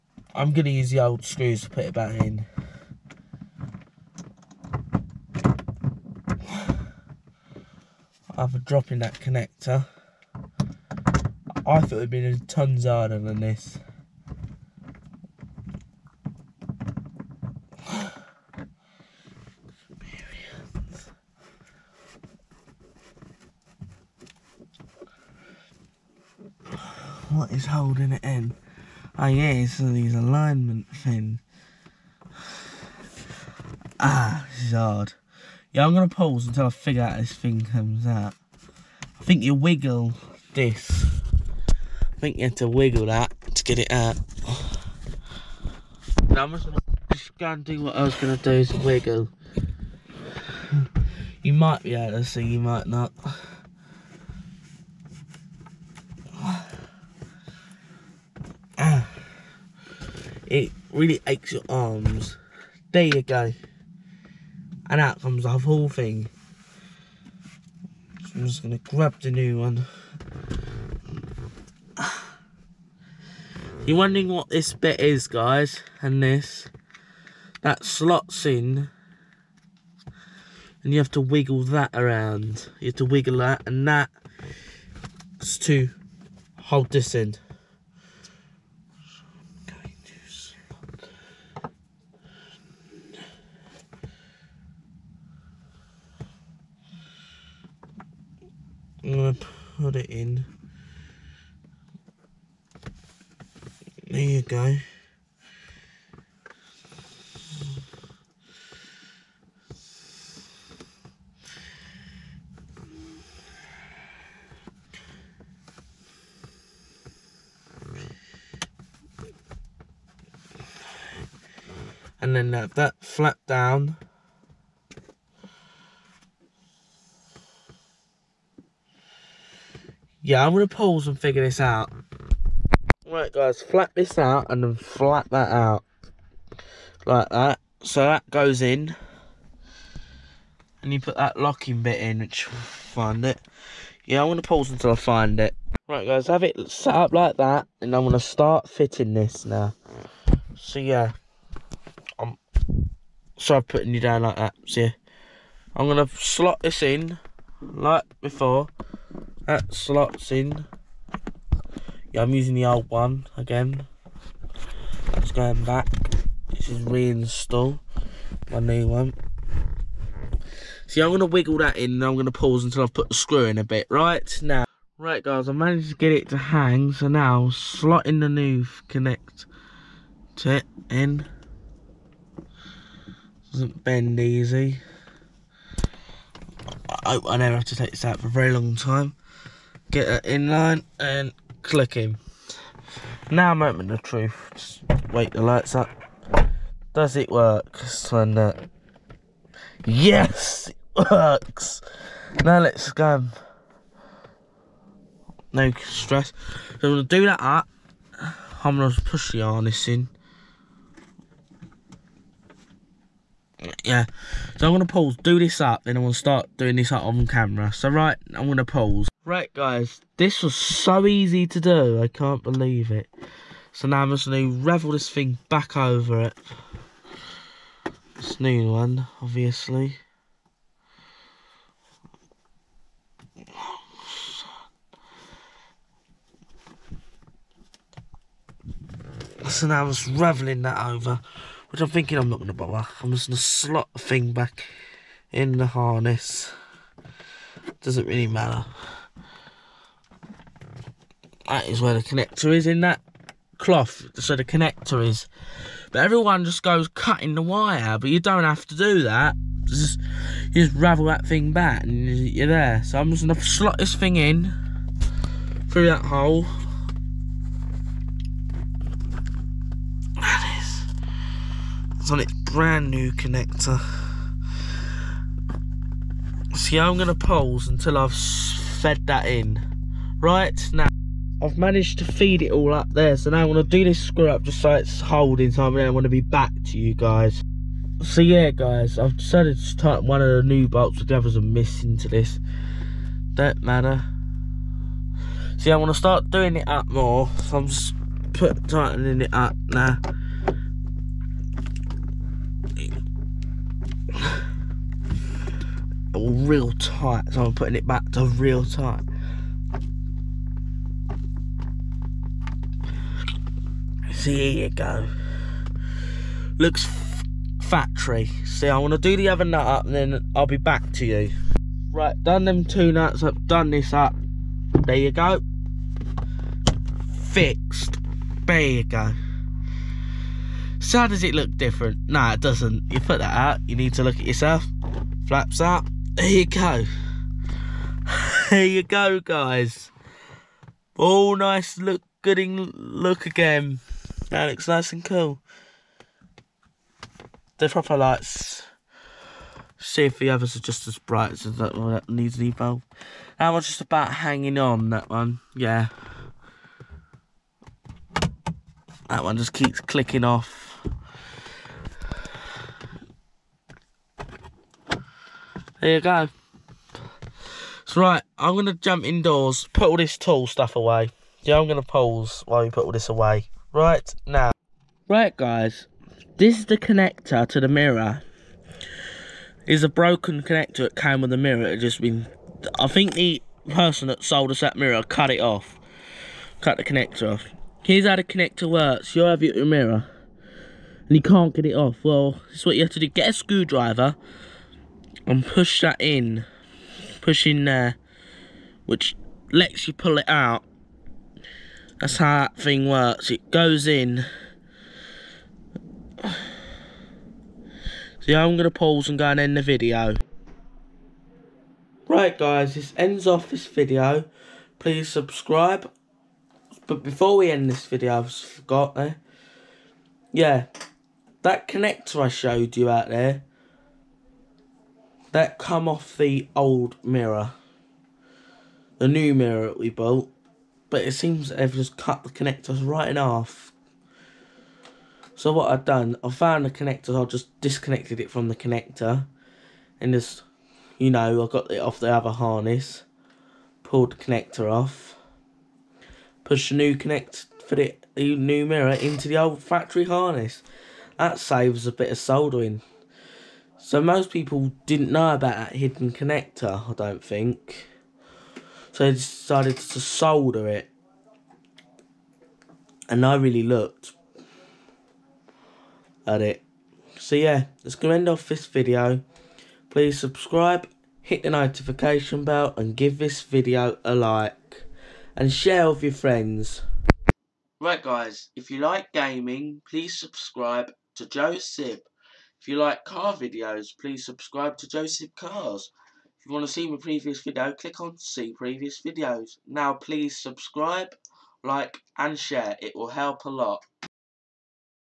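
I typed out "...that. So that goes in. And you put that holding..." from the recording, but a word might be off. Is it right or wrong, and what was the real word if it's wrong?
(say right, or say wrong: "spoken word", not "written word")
wrong: "locking", not "holding".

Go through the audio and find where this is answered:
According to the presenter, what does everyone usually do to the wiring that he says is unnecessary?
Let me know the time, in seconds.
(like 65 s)
256 s.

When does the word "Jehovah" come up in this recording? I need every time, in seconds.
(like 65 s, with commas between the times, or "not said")
not said.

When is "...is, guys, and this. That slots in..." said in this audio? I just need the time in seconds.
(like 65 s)
74 s.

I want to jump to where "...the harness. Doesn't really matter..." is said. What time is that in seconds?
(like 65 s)
245 s.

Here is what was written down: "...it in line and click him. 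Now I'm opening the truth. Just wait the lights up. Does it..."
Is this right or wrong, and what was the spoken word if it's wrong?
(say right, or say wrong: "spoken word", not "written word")
right.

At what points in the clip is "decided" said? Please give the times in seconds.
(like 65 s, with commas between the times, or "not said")
289 s, 459 s.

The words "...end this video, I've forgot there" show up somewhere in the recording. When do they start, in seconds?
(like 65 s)
417 s.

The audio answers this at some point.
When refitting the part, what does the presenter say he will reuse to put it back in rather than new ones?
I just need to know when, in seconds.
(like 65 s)
0 s.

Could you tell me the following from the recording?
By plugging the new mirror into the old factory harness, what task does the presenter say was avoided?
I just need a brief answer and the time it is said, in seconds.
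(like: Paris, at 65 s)
soldering, at 452 s.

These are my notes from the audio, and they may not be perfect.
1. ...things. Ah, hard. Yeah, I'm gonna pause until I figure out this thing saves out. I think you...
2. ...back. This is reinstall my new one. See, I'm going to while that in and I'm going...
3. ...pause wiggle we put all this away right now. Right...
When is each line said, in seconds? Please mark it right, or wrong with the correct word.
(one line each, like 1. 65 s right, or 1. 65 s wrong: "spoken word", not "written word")
1. 30 s wrong: "comes", not "saves"
2. 165 s wrong: "wiggle", not "while"
3. 371 s wrong: "while", not "wiggle".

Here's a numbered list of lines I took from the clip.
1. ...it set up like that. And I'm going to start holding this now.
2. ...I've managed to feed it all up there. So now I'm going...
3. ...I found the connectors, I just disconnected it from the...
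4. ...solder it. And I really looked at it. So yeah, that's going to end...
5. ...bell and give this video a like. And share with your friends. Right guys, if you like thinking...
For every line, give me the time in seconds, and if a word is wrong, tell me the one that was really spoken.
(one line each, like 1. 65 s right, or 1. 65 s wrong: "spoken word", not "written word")
1. 146 s wrong: "fitting", not "holding"
2. 281 s right
3. 436 s right
4. 460 s right
5. 472 s wrong: "gaming", not "thinking".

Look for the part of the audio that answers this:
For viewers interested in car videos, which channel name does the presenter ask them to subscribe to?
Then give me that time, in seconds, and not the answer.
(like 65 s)
484 s.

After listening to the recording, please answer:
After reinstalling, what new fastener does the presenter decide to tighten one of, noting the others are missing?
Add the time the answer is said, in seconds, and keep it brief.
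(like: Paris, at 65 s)
bolts, at 290 s.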